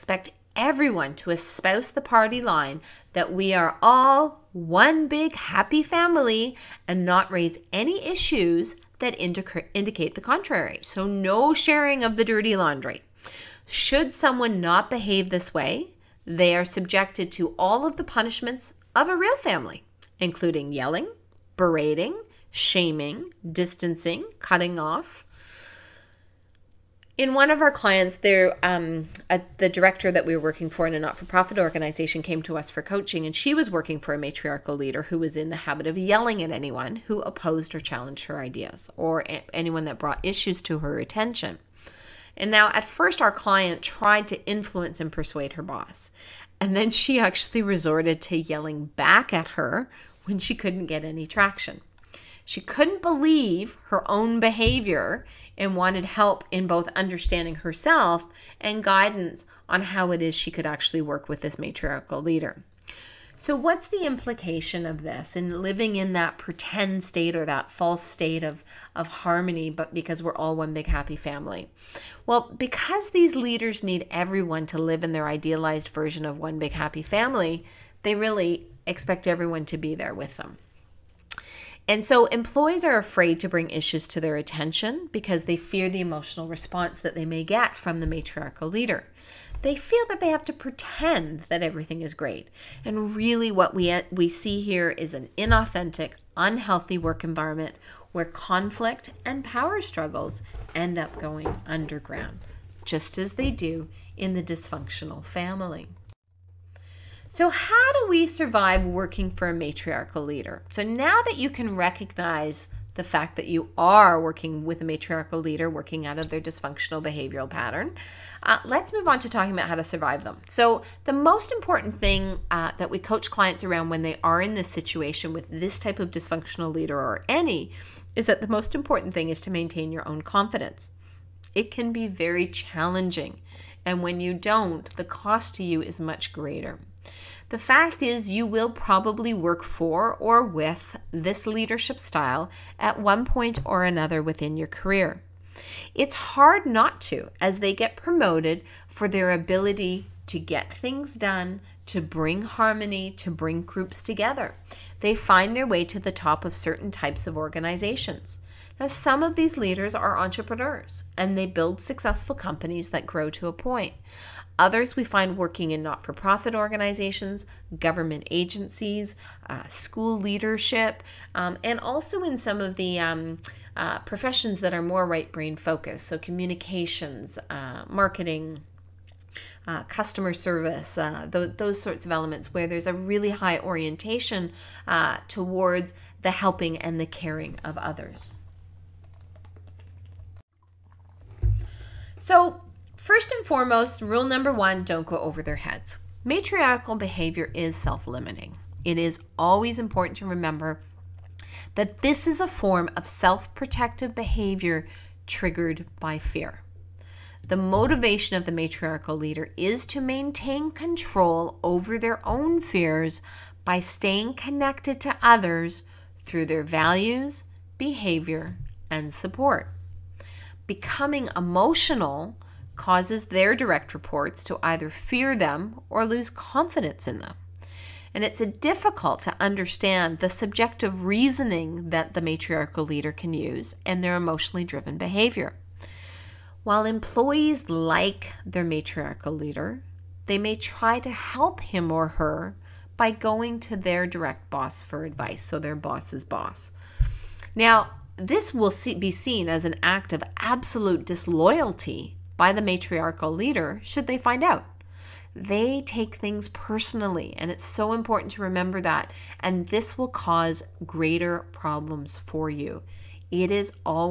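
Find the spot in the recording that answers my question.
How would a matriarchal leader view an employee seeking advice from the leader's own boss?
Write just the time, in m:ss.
4:10.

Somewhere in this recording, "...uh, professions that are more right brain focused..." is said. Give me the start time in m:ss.
2:53.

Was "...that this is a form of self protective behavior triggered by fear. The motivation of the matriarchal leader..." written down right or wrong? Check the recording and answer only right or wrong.
right.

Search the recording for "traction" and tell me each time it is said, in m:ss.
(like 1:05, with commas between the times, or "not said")
0:51.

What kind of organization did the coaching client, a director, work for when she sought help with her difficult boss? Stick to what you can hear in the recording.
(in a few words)
Not-for-profit organization.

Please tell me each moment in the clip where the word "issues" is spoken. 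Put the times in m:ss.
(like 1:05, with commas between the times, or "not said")
0:08, 0:40, 1:23.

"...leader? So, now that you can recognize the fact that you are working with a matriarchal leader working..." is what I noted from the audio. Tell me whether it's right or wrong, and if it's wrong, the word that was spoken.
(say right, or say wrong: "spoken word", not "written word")
right.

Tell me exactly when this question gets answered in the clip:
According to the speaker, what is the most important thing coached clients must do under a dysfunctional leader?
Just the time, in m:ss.
2:09.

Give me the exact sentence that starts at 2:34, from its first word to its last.
They find their way to the top of certain types of organizations.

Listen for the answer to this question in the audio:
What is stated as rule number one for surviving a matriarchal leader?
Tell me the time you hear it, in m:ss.
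3:14.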